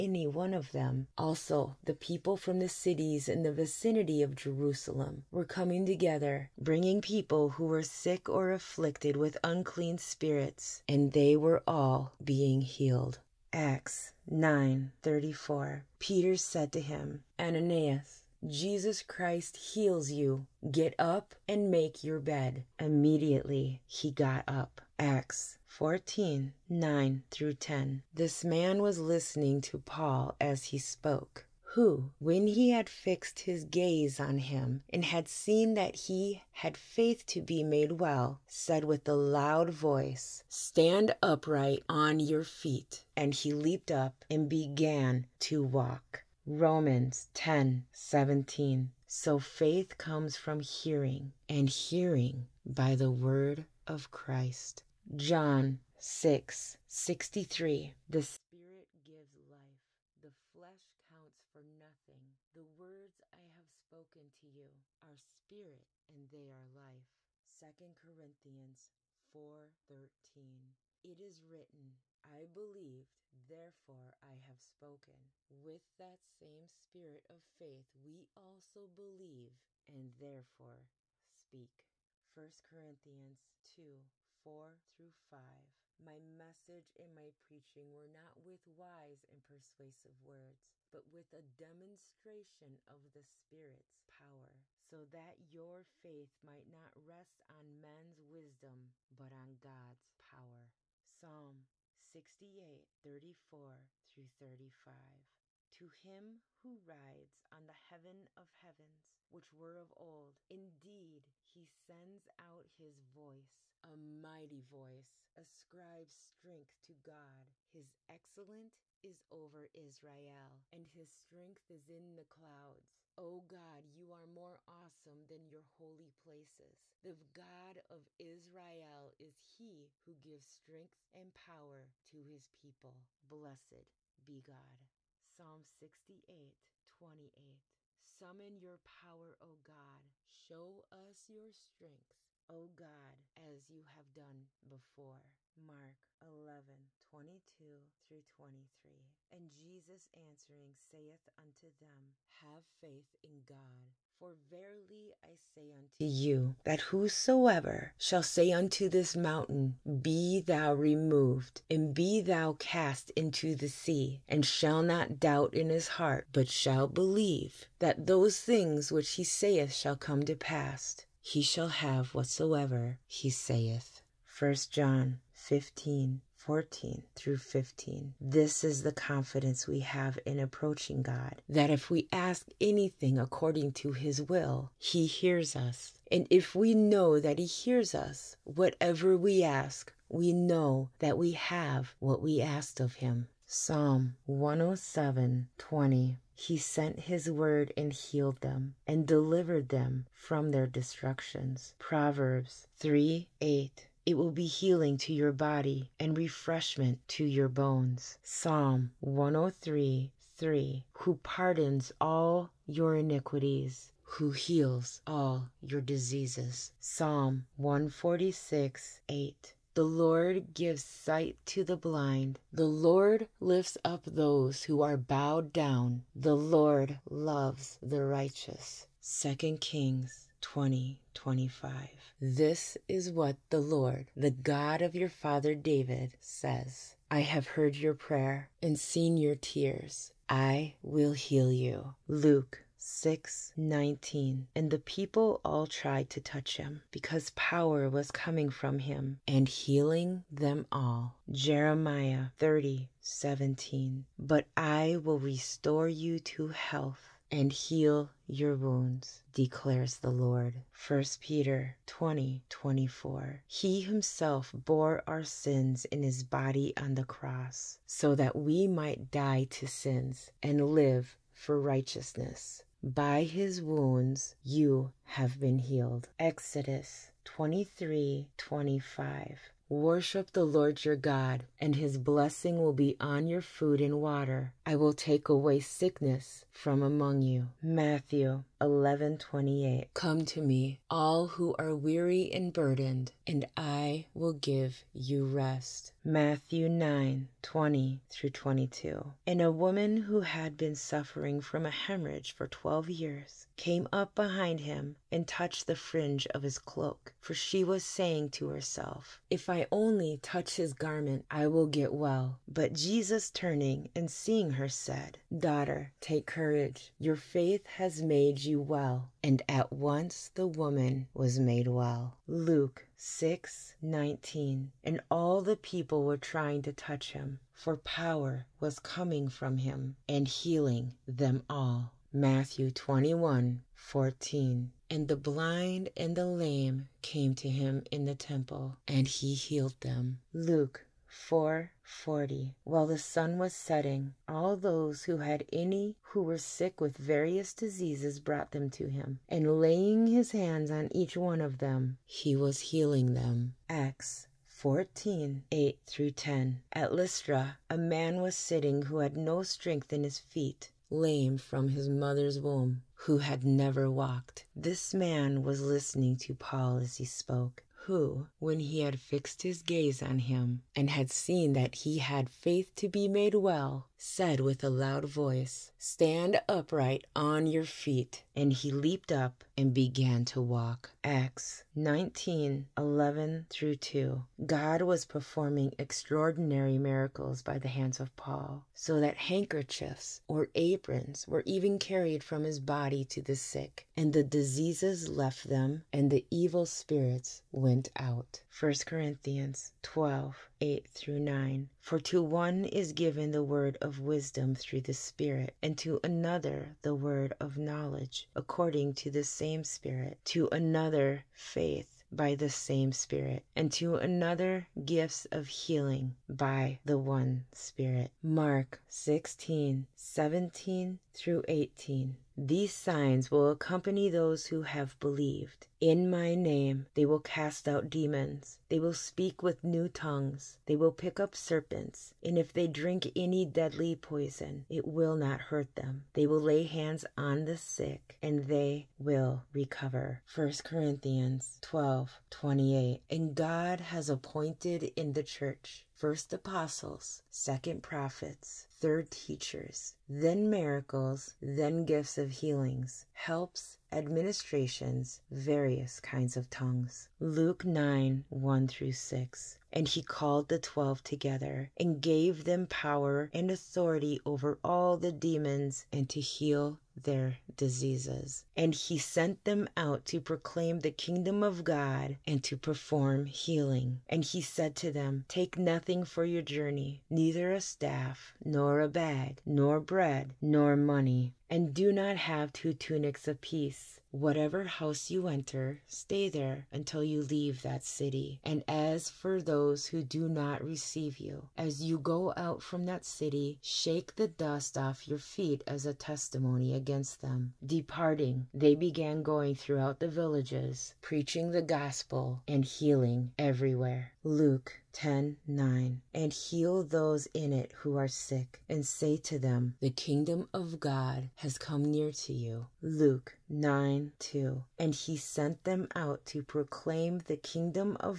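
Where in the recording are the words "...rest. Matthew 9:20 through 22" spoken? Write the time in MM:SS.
04:55.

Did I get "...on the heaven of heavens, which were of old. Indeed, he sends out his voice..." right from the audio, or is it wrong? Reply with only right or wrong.
right.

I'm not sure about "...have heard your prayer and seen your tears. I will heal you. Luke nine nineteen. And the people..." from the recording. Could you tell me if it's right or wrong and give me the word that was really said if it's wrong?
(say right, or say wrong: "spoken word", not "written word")
wrong: "six", not "nine".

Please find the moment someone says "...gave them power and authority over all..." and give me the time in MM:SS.
07:42.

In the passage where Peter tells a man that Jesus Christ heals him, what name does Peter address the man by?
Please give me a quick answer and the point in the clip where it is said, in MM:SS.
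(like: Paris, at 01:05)
Ananias, at 00:17.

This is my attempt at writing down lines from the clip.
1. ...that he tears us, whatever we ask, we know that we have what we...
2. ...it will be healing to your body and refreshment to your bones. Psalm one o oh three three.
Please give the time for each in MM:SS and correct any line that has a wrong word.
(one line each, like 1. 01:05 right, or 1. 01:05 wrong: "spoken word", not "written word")
1. 03:07 wrong: "hears", not "tears"
2. 03:24 right.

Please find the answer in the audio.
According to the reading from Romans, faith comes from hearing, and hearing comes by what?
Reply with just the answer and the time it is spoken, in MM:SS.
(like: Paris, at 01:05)
the word of Christ, at 00:52.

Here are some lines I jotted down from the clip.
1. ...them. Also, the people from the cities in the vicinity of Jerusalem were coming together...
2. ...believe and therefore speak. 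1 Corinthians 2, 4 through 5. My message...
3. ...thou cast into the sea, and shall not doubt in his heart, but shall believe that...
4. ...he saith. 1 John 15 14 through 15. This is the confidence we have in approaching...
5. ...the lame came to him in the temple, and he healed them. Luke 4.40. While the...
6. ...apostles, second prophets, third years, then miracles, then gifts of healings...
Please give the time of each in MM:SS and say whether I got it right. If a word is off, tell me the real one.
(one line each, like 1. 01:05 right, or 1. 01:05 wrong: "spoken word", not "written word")
1. 00:00 right
2. 01:18 right
3. 02:42 right
4. 02:53 right
5. 05:36 right
6. 07:26 wrong: "teachers", not "years".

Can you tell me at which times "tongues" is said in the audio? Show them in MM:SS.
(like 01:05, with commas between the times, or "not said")
07:09, 07:36.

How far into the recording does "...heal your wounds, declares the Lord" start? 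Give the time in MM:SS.
04:17.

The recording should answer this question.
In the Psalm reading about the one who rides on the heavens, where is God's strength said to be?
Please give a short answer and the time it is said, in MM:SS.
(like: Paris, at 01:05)
in the clouds, at 02:01.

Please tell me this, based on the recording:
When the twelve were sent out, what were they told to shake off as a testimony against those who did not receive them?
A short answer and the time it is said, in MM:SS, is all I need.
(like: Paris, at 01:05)
dust off your feet, at 08:14.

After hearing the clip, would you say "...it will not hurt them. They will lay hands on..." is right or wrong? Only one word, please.
right.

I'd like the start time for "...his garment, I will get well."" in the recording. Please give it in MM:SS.
05:10.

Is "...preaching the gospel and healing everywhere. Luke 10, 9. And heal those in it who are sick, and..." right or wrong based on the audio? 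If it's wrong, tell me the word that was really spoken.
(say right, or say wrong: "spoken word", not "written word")
right.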